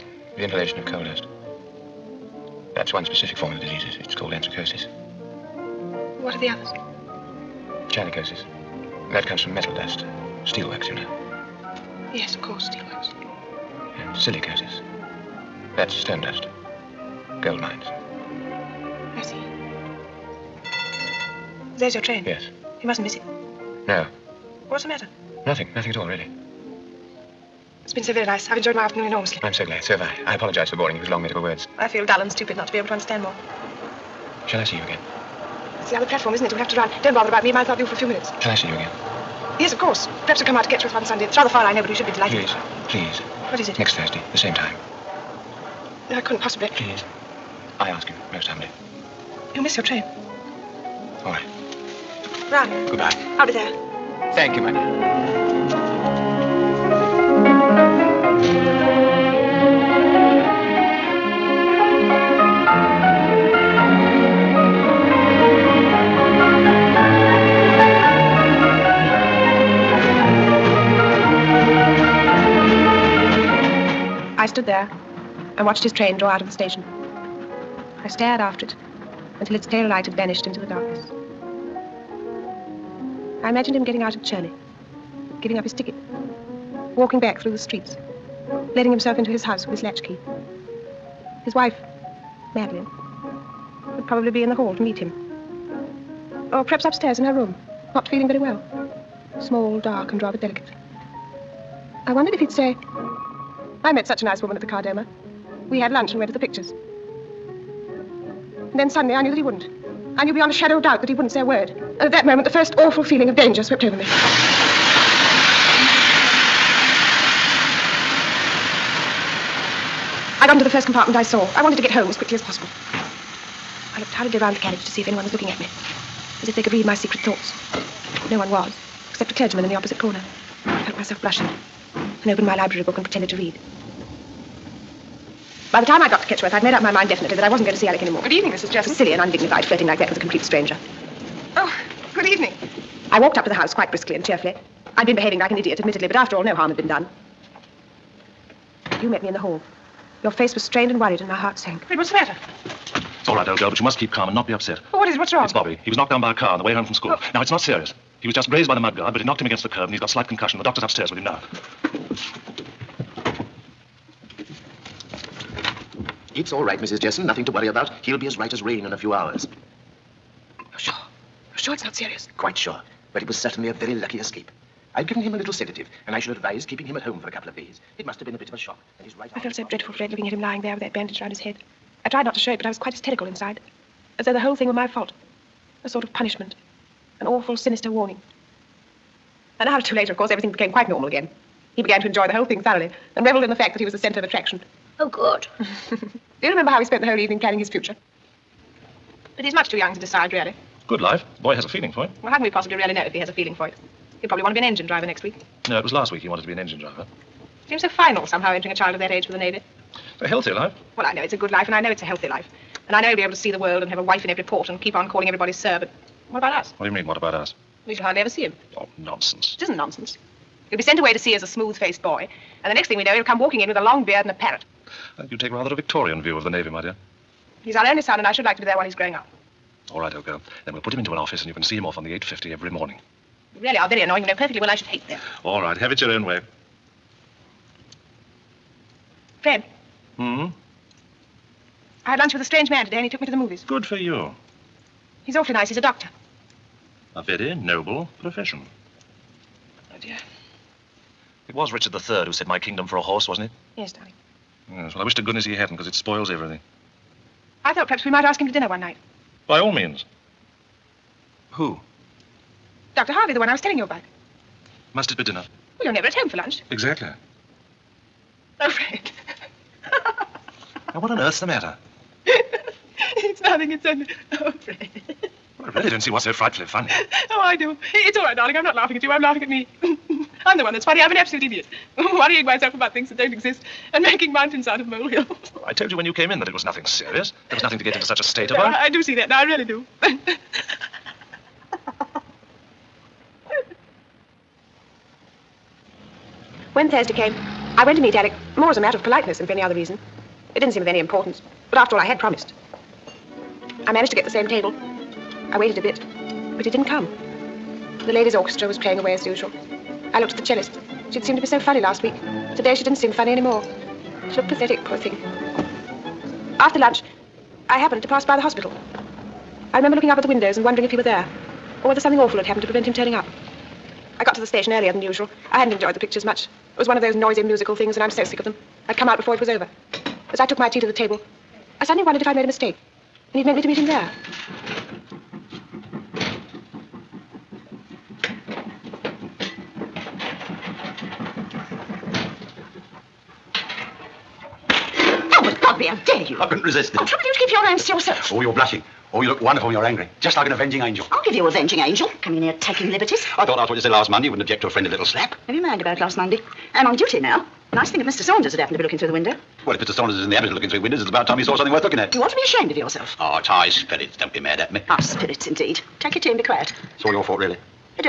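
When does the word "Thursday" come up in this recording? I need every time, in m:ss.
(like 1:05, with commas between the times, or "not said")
0:43, 4:56.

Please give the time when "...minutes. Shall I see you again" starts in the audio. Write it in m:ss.
0:38.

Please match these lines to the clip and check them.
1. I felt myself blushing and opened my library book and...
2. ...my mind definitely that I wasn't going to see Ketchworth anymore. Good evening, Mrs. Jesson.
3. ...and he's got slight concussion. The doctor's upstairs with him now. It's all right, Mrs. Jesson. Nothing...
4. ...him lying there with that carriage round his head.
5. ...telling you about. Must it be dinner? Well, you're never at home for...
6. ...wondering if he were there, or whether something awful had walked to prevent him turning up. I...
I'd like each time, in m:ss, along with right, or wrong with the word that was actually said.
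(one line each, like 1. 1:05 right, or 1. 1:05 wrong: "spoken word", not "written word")
1. 2:10 right
2. 2:16 wrong: "Alec", not "Ketchworth"
3. 2:39 right
4. 3:00 wrong: "bandage", not "carriage"
5. 4:23 right
6. 5:20 wrong: "happened", not "walked".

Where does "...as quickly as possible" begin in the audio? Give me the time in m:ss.
2:02.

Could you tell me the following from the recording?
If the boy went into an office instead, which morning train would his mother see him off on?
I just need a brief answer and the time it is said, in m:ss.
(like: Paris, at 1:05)
The 8.50, at 3:52.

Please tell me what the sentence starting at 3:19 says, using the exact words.
But he's much too young to decide, really.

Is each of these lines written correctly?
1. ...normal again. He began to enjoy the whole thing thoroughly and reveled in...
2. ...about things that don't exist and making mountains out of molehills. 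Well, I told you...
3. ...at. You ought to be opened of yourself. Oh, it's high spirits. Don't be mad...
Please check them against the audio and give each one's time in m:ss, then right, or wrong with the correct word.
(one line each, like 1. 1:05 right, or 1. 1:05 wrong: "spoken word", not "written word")
1. 3:10 right
2. 4:42 right
3. 6:01 wrong: "ashamed", not "opened".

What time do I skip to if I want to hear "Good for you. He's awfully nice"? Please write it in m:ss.
4:03.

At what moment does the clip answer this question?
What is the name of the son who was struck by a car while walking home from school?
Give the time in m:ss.
2:35.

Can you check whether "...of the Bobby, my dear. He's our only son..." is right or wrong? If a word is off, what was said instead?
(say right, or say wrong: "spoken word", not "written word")
wrong: "Navy", not "Bobby".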